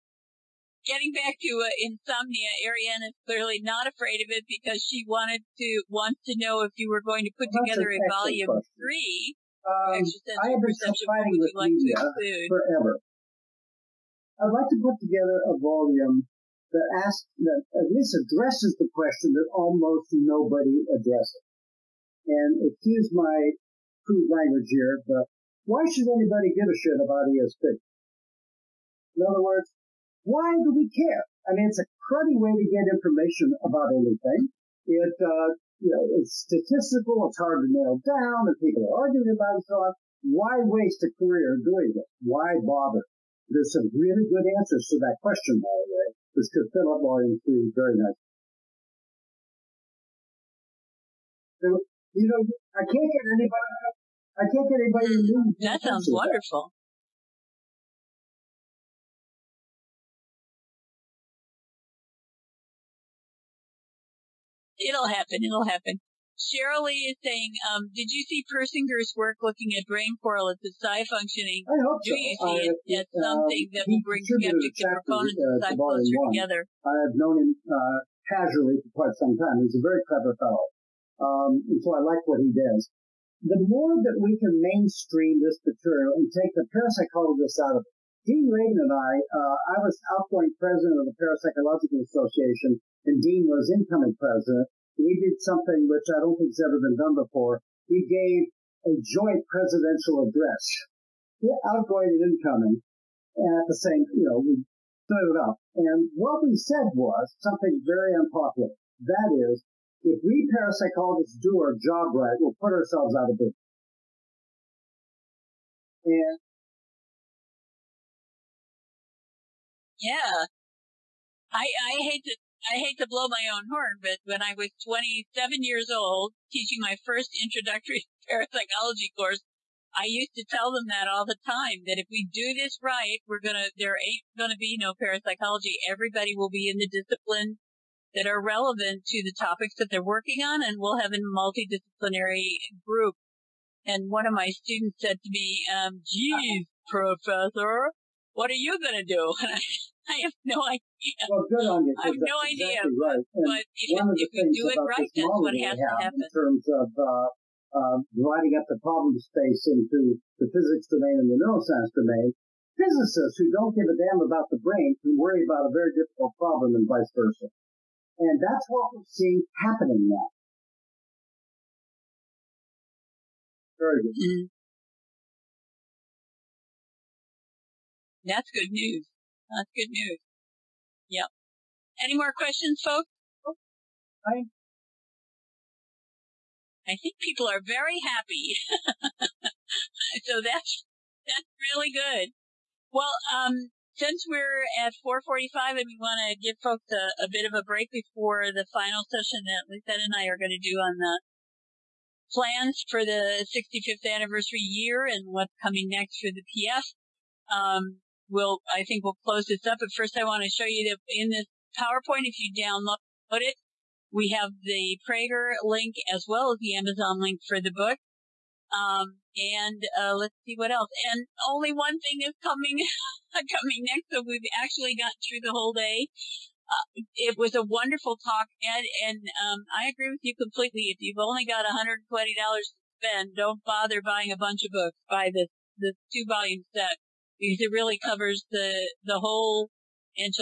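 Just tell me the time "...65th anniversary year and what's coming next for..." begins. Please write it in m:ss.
3:23.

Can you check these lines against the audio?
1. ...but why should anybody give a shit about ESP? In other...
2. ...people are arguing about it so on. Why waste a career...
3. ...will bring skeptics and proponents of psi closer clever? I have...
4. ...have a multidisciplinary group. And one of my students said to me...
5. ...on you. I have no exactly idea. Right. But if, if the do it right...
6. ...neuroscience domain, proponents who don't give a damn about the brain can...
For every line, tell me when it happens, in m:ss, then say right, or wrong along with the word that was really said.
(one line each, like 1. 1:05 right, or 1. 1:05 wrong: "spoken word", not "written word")
1. 0:25 right
2. 0:38 right
3. 1:13 wrong: "together", not "clever"
4. 2:20 right
5. 2:31 right
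6. 2:41 wrong: "physicists", not "proponents".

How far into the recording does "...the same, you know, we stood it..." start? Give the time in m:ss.
1:43.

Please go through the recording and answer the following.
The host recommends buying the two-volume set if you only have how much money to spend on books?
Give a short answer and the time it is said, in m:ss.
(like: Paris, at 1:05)
$120, at 3:51.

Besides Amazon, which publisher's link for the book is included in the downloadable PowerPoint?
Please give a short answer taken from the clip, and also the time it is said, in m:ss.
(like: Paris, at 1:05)
Praeger, at 3:35.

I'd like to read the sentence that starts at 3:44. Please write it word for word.
So we've actually got through the whole day.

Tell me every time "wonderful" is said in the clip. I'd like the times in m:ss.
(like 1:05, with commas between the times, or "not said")
0:56, 3:47.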